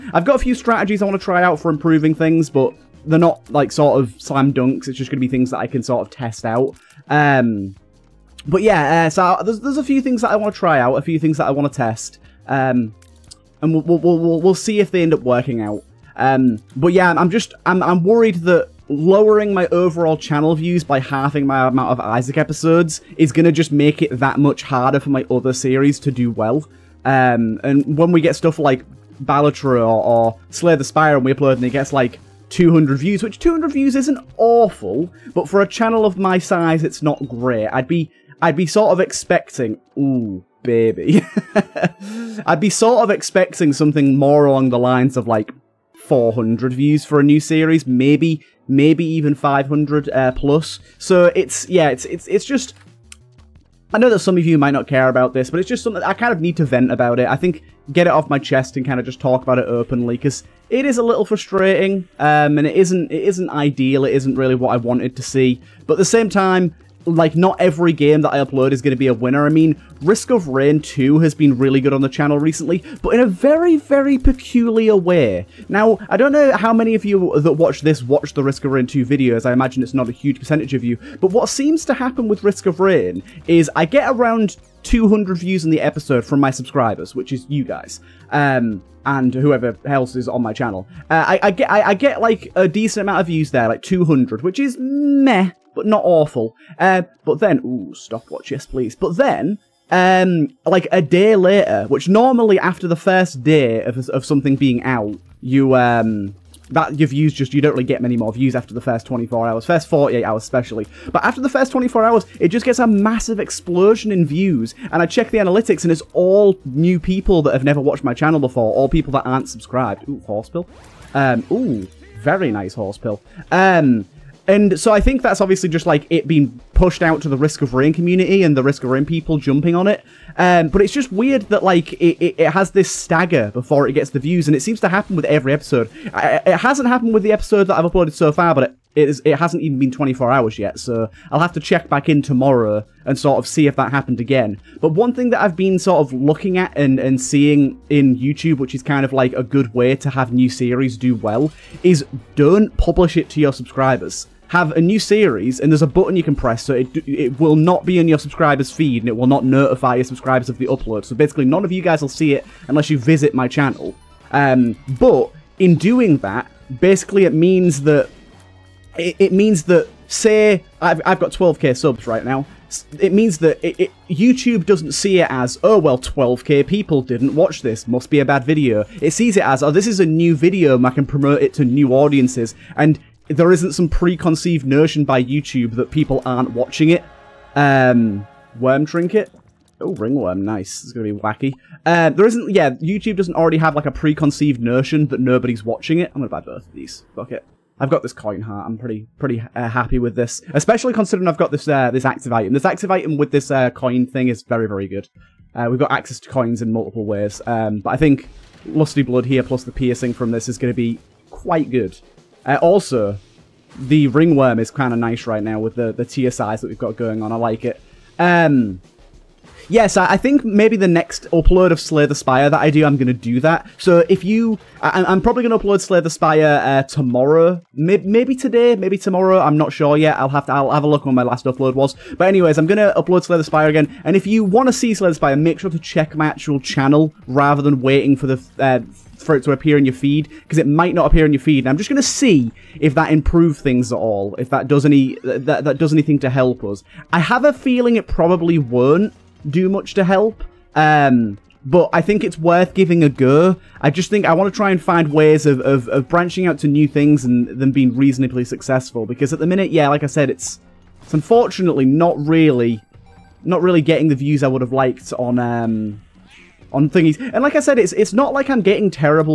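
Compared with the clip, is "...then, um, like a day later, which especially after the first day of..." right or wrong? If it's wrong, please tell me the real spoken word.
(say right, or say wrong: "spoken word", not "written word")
wrong: "normally", not "especially".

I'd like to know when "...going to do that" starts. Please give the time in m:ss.
3:42.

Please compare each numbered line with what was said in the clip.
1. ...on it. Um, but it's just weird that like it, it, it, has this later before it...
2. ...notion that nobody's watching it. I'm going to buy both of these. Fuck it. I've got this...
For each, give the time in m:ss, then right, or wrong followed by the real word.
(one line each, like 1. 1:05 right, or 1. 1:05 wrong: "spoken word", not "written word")
1. 2:09 wrong: "stagger", not "later"
2. 3:14 right.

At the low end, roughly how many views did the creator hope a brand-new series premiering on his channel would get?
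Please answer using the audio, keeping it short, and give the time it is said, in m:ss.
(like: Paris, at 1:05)
400, at 0:46.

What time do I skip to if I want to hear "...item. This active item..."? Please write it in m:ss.
3:22.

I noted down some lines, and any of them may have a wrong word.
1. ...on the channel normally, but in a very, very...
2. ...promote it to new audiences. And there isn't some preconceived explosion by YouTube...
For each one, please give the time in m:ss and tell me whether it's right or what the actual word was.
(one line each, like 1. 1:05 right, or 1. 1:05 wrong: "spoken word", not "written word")
1. 1:11 wrong: "recently", not "normally"
2. 3:01 wrong: "notion", not "explosion".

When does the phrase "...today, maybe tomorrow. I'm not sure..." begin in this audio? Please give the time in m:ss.
3:48.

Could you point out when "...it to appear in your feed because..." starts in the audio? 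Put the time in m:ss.
3:59.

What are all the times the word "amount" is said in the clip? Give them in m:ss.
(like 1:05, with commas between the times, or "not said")
0:21, 1:33.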